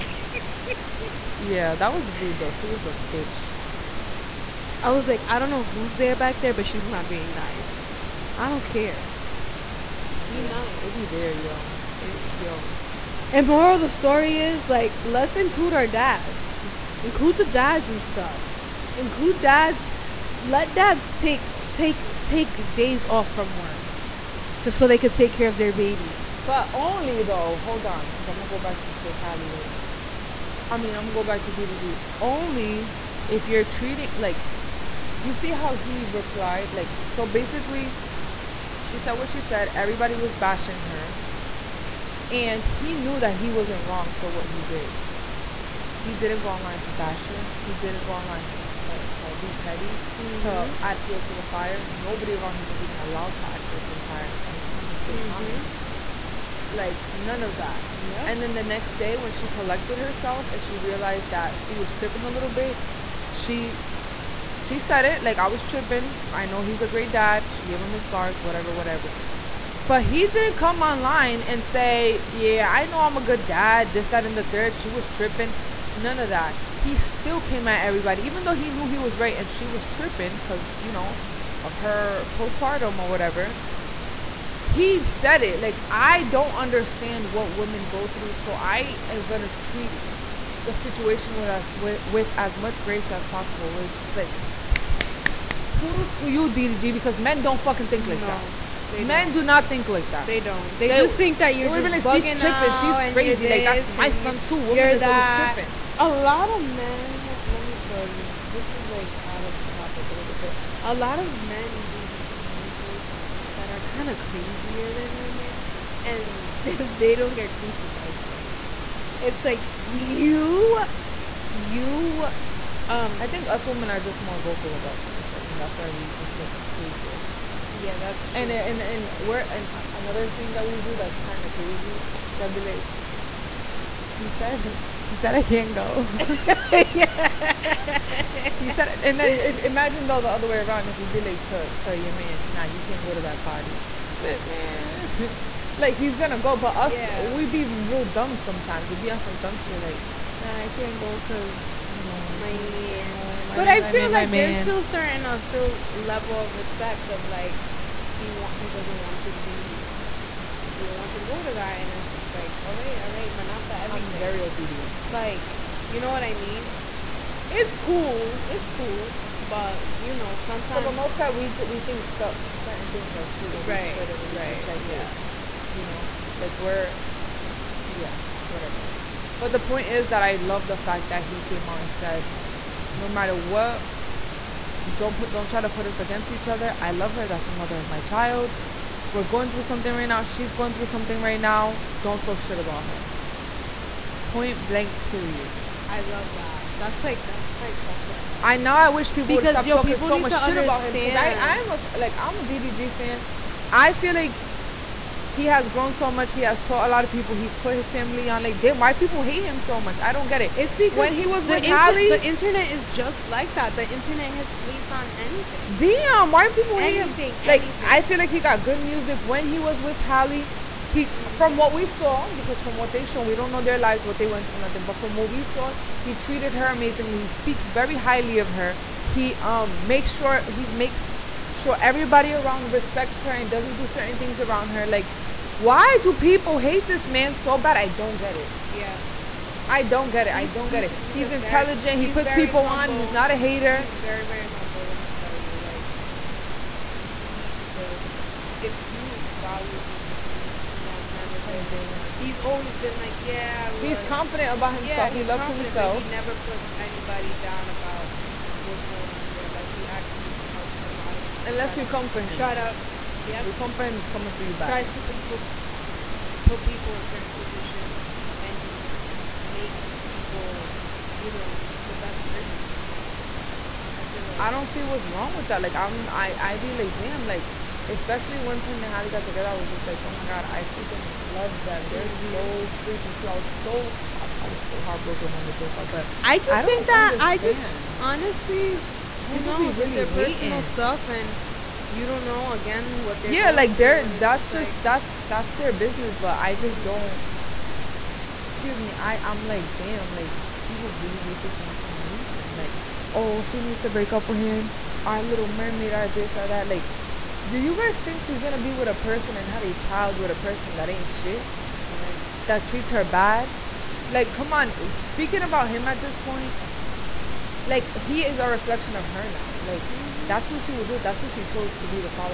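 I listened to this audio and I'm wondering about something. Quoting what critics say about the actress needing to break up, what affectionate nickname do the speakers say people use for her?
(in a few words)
Our little mermaid.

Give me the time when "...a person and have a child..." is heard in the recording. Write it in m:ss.
5:08.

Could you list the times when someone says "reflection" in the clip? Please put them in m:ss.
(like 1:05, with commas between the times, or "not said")
5:18.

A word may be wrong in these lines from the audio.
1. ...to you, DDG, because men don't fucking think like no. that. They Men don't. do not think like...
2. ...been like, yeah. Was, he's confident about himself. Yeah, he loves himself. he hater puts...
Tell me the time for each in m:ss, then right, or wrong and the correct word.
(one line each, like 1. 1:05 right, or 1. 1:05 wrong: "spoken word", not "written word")
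1. 1:36 right
2. 4:12 wrong: "never", not "hater".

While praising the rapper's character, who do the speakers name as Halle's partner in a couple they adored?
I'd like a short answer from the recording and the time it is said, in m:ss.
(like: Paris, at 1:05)
Tim, at 4:38.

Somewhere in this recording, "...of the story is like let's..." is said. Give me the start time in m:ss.
0:13.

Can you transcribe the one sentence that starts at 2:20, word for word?
If you would be like to to your man, nah, you can't go to that party, but man.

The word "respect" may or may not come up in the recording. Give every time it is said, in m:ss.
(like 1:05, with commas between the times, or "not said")
2:36, 3:52.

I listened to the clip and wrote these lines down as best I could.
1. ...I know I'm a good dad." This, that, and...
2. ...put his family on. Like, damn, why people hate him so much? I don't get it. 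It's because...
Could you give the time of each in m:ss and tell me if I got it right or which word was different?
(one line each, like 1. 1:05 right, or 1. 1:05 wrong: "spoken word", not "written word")
1. 1:12 right
2. 3:27 right.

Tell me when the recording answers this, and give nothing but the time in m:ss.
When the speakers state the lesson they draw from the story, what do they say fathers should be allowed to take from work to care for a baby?
0:22.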